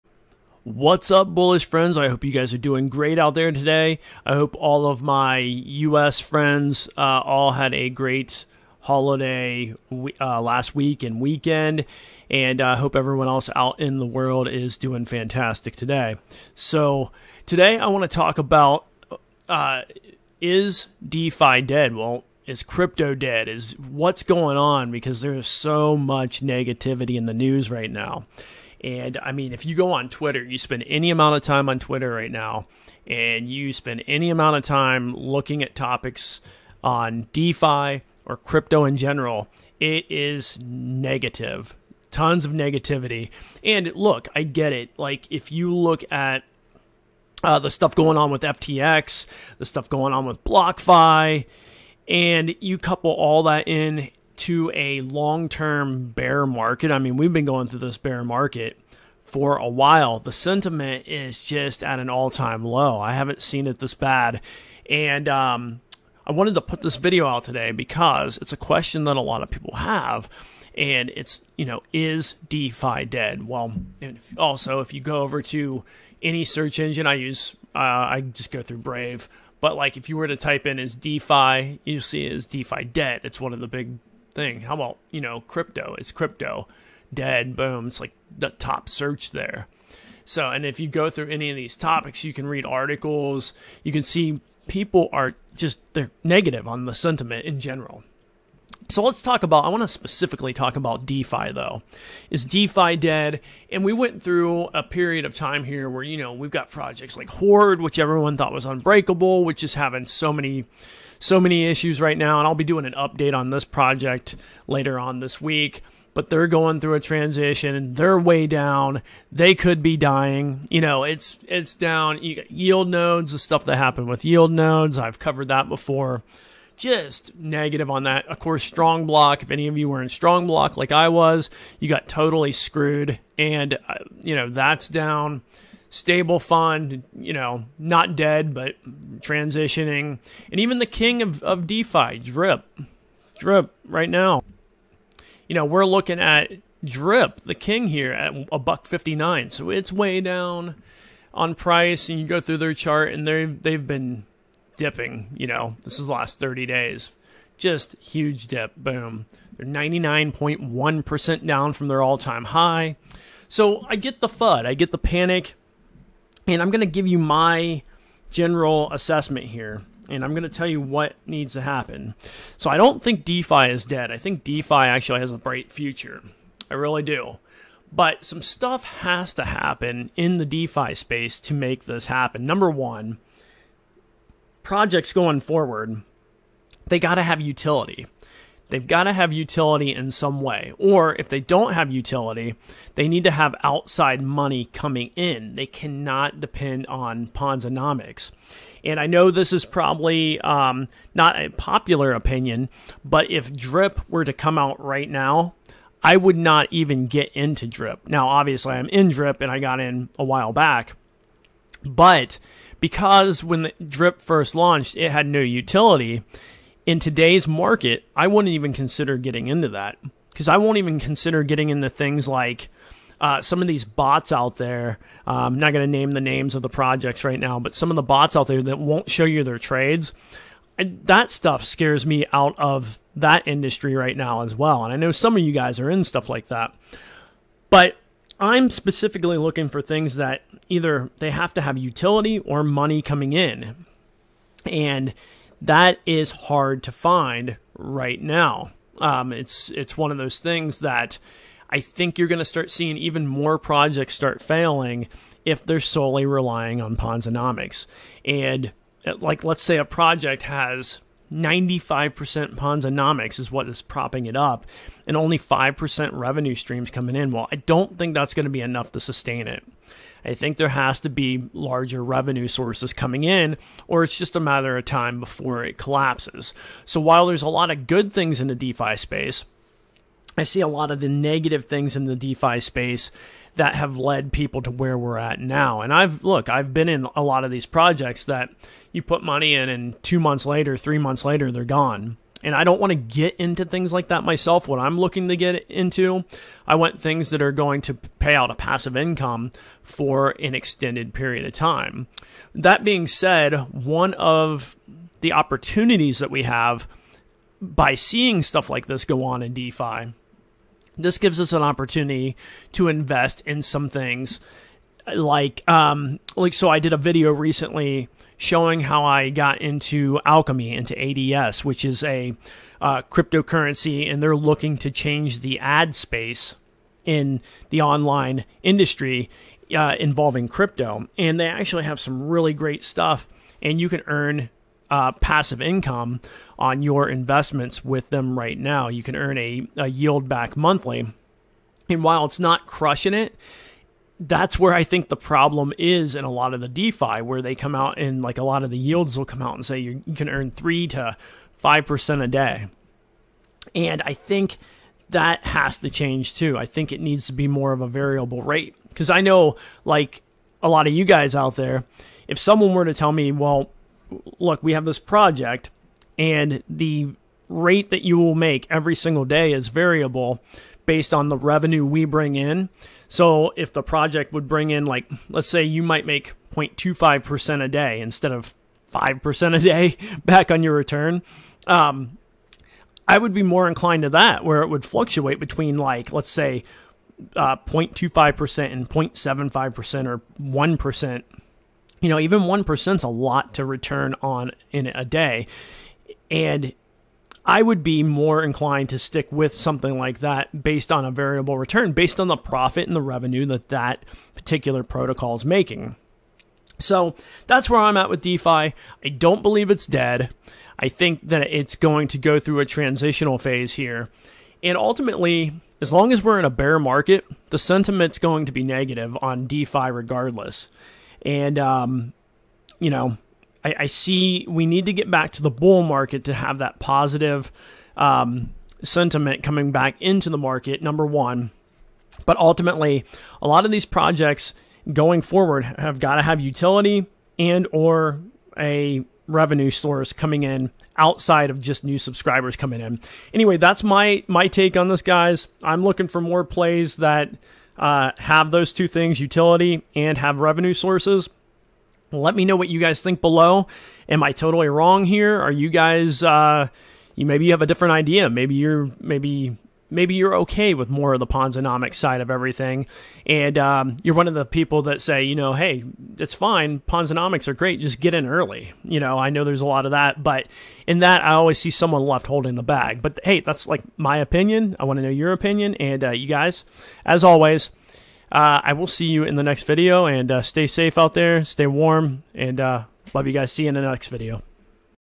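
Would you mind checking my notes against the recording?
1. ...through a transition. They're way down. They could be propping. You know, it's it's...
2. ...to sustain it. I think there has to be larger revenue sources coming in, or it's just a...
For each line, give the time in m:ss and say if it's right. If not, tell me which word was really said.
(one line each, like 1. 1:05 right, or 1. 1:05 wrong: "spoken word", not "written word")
1. 1:56 wrong: "dying", not "propping"
2. 4:28 right.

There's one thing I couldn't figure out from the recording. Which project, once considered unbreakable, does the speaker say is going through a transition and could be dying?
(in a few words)
Horde.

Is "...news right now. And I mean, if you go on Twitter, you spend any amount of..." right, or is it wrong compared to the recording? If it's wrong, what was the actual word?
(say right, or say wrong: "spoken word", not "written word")
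right.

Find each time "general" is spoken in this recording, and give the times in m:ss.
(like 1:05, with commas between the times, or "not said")
0:38, 1:37, 2:48.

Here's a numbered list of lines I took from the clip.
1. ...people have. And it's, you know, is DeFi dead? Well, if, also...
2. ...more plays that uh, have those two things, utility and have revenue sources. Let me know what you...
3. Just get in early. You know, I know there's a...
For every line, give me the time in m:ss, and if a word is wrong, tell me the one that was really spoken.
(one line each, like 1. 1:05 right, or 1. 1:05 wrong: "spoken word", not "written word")
1. 1:09 right
2. 7:26 right
3. 7:47 right.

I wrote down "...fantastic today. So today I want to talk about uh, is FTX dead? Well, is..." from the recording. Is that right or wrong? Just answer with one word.
wrong.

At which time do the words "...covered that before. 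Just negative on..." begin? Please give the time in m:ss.
2:05.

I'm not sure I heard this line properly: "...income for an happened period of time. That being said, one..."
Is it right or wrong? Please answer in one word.
wrong.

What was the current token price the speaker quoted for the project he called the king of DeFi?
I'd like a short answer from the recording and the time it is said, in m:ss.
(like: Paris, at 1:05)
$1.59, at 2:28.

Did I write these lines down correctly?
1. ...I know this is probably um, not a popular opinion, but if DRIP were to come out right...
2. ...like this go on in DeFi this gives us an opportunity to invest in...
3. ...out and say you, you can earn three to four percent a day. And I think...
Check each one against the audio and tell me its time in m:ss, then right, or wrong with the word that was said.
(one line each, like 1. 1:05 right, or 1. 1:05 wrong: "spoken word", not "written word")
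1. 3:18 right
2. 5:08 right
3. 5:49 wrong: "five", not "four".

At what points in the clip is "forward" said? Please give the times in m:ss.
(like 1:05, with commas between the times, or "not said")
3:05, 7:15.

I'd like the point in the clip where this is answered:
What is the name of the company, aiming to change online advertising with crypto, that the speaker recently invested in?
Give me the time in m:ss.
5:20.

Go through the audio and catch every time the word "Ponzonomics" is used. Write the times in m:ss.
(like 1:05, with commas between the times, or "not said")
3:17, 4:16, 4:22, 7:41, 7:46.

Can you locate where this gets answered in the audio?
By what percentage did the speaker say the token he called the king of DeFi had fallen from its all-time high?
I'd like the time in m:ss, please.
2:39.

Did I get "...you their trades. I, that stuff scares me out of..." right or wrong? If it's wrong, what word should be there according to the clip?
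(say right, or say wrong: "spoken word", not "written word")
right.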